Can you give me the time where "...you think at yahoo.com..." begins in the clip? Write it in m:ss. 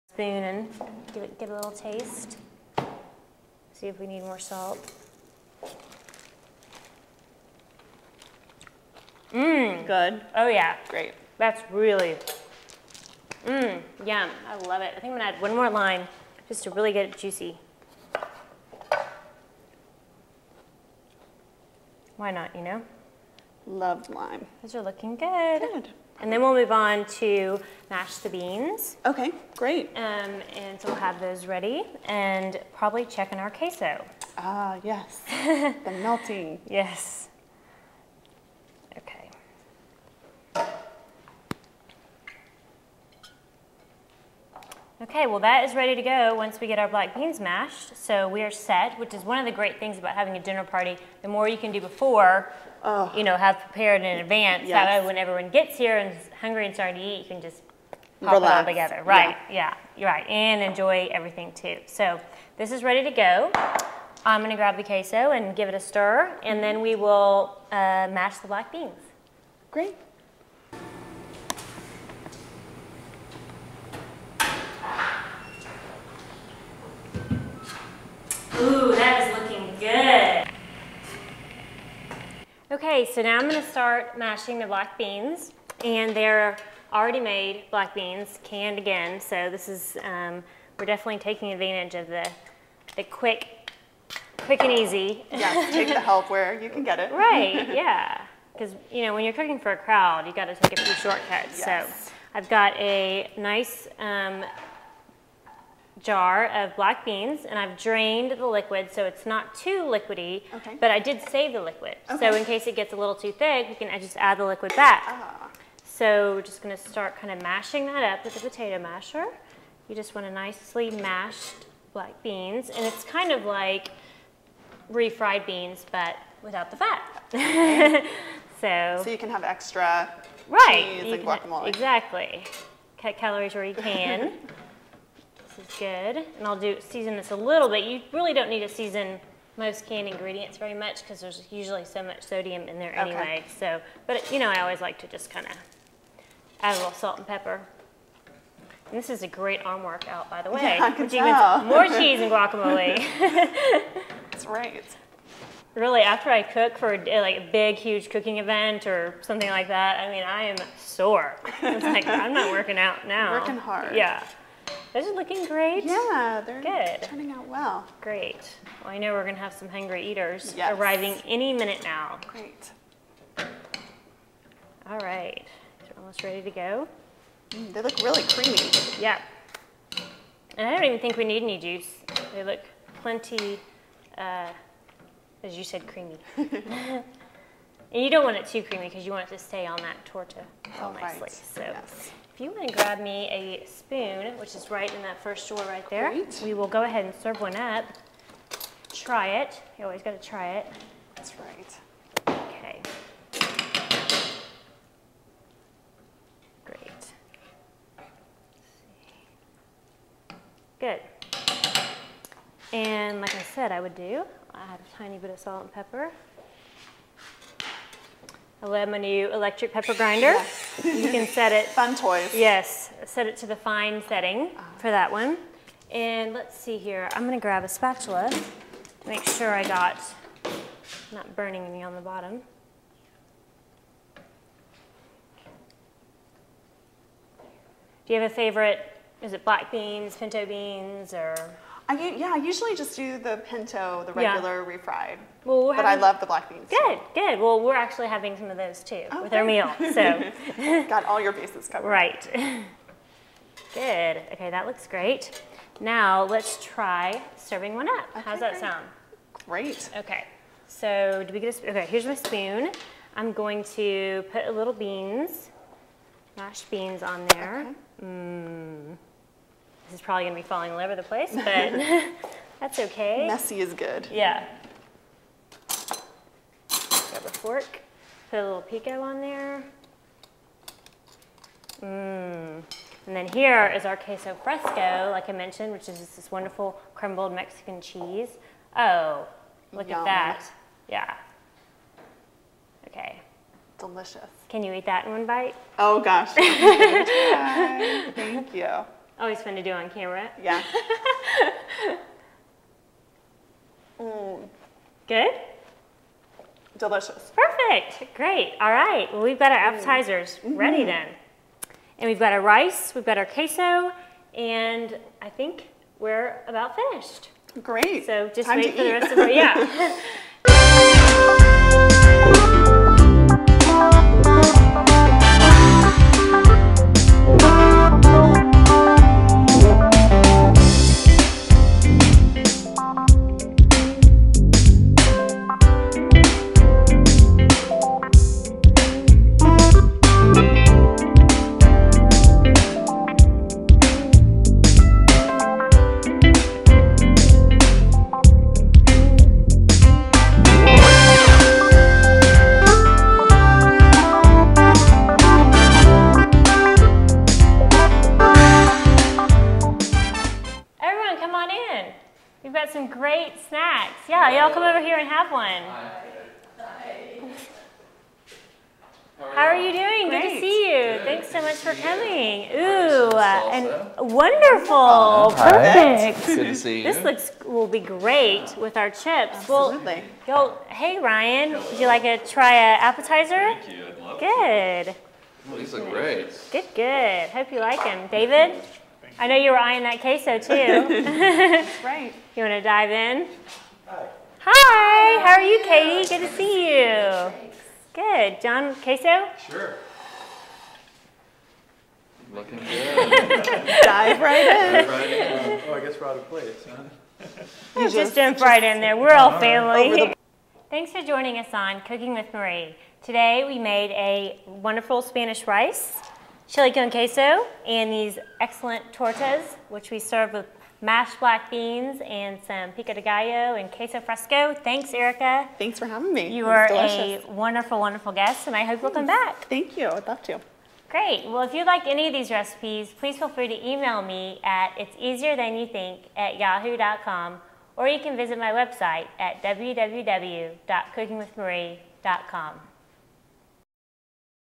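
7:15.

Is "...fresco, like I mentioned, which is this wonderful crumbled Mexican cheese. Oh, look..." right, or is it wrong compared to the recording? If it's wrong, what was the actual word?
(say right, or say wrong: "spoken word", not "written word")
right.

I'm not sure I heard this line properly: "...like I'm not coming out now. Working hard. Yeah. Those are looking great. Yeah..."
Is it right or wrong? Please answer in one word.
wrong.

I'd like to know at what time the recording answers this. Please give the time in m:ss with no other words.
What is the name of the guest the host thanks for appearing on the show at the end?
7:04.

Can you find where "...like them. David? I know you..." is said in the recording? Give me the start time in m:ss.
6:27.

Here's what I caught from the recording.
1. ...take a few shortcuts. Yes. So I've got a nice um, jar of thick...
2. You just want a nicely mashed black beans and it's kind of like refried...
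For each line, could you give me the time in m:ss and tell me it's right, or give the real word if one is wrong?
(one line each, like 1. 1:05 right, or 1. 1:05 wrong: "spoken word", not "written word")
1. 1:40 wrong: "black", not "thick"
2. 1:59 right.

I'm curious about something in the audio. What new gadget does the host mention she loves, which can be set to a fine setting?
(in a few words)
electric pepper grinder.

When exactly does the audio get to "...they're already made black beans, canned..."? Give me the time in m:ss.
1:26.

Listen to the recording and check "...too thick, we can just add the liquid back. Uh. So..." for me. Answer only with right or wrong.
right.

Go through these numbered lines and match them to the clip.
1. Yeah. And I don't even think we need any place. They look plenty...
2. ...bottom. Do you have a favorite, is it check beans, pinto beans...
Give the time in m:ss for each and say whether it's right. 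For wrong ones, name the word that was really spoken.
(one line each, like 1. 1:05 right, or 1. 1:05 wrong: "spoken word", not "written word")
1. 2:58 wrong: "juice", not "place"
2. 3:52 wrong: "black", not "check".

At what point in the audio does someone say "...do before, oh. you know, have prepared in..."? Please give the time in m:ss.
0:51.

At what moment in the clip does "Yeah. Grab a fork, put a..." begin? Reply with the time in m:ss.
4:34.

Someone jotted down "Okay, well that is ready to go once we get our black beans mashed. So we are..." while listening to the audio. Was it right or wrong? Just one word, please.
right.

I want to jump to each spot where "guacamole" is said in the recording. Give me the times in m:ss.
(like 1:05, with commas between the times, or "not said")
2:11, 2:32.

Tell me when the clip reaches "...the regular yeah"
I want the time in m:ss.
4:04.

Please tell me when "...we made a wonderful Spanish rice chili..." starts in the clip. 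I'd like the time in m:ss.
6:53.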